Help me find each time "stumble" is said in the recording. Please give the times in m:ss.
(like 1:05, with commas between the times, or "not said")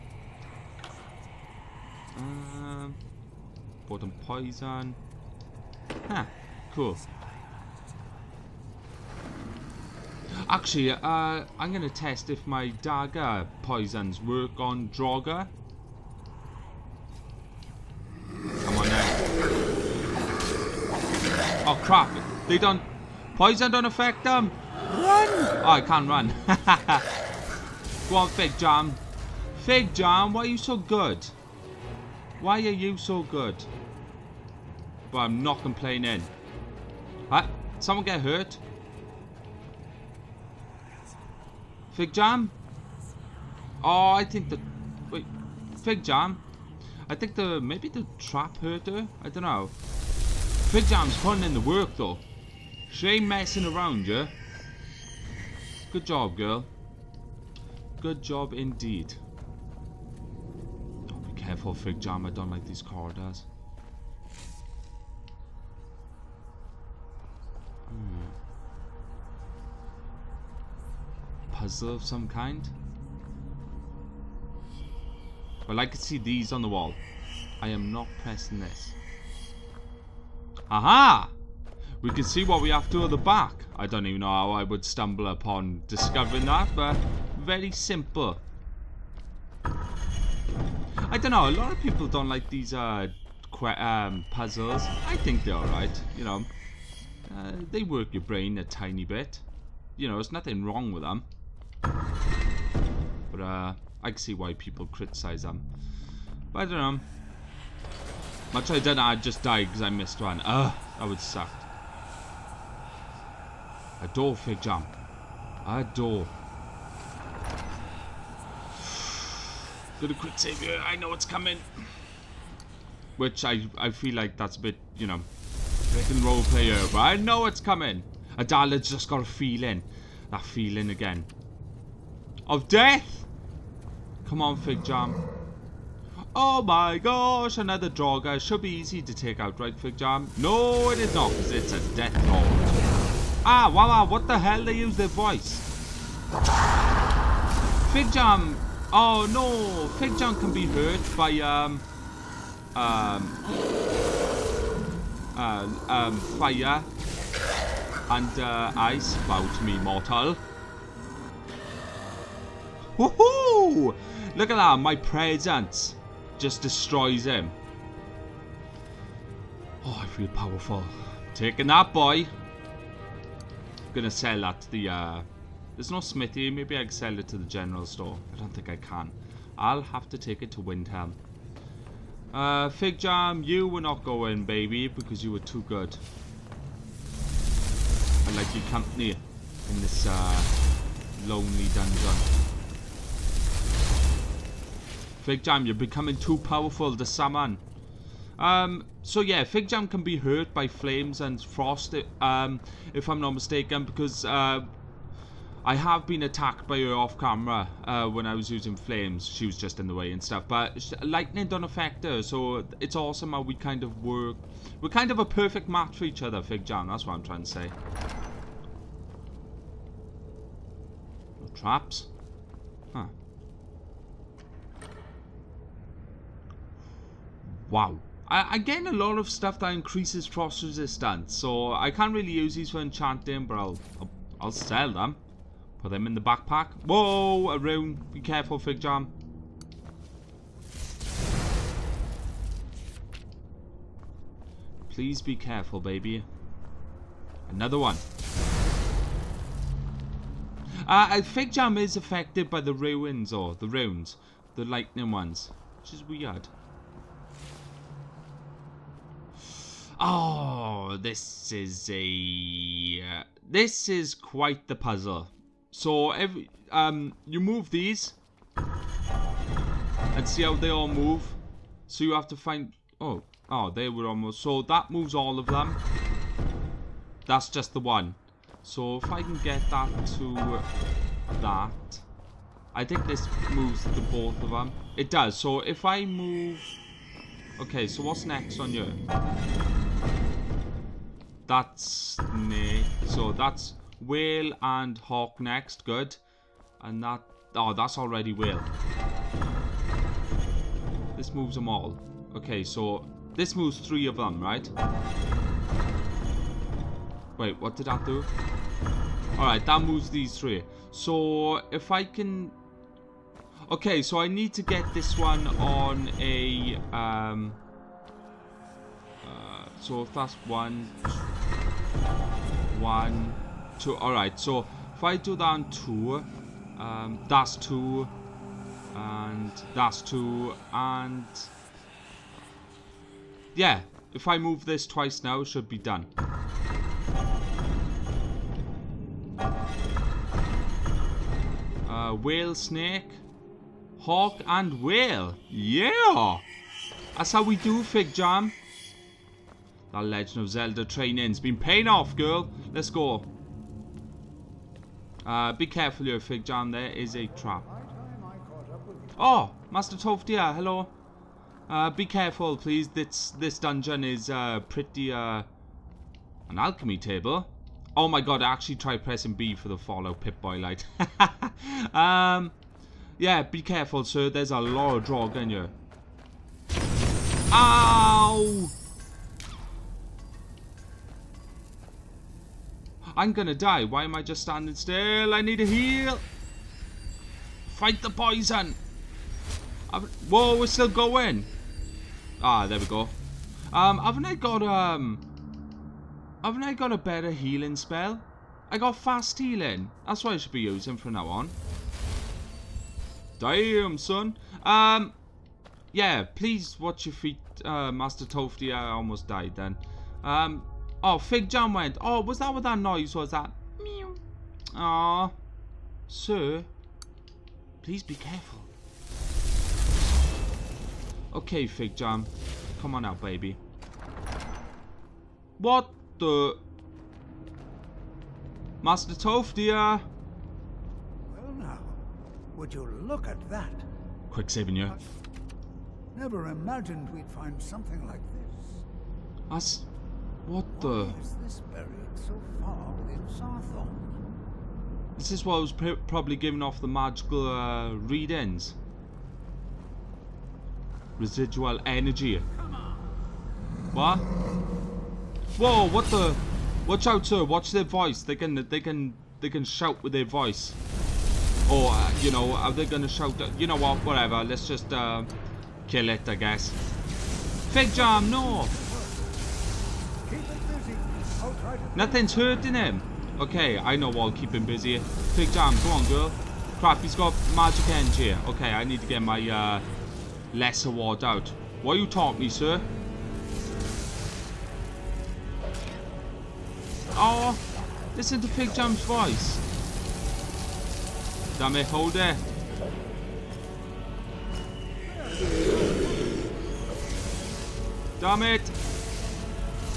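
1:24.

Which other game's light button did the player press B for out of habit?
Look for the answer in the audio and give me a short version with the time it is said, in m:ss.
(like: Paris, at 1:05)
Fallout, at 6:09.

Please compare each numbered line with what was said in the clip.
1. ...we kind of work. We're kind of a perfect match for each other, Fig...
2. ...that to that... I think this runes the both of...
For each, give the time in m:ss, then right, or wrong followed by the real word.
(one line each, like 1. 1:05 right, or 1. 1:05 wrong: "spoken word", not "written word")
1. 3:33 right
2. 4:39 wrong: "moves", not "runes".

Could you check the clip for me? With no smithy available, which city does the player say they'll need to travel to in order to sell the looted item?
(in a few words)
Windhelm.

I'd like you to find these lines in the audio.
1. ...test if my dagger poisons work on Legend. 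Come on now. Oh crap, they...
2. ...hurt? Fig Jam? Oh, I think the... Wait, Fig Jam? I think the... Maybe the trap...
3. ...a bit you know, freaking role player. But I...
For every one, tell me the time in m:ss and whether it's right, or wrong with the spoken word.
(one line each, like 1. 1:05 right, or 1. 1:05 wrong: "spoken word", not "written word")
1. 0:11 wrong: "Draugr", not "Legend"
2. 0:38 right
3. 2:04 right.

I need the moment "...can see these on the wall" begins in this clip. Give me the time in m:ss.
1:15.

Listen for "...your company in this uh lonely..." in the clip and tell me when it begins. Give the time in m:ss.
3:08.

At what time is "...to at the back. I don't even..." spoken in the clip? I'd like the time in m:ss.
1:22.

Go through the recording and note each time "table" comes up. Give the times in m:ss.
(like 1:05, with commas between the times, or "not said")
6:06.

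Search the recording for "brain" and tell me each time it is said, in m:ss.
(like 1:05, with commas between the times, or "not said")
1:38.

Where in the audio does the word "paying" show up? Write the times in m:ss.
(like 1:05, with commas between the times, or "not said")
5:51.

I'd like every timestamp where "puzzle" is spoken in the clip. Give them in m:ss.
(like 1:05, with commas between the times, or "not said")
1:11, 1:34, 4:24.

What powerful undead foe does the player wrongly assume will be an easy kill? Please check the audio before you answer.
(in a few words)
Death Lord.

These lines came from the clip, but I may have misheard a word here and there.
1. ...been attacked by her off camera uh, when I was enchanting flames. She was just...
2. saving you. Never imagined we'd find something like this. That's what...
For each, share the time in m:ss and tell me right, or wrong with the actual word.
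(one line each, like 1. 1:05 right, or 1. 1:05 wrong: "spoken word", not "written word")
1. 3:26 wrong: "using", not "enchanting"
2. 7:14 right.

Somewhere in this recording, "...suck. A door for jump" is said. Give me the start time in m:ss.
1:51.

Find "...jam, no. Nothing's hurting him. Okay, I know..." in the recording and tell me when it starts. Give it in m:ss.
7:47.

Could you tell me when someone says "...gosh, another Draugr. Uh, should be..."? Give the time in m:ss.
2:16.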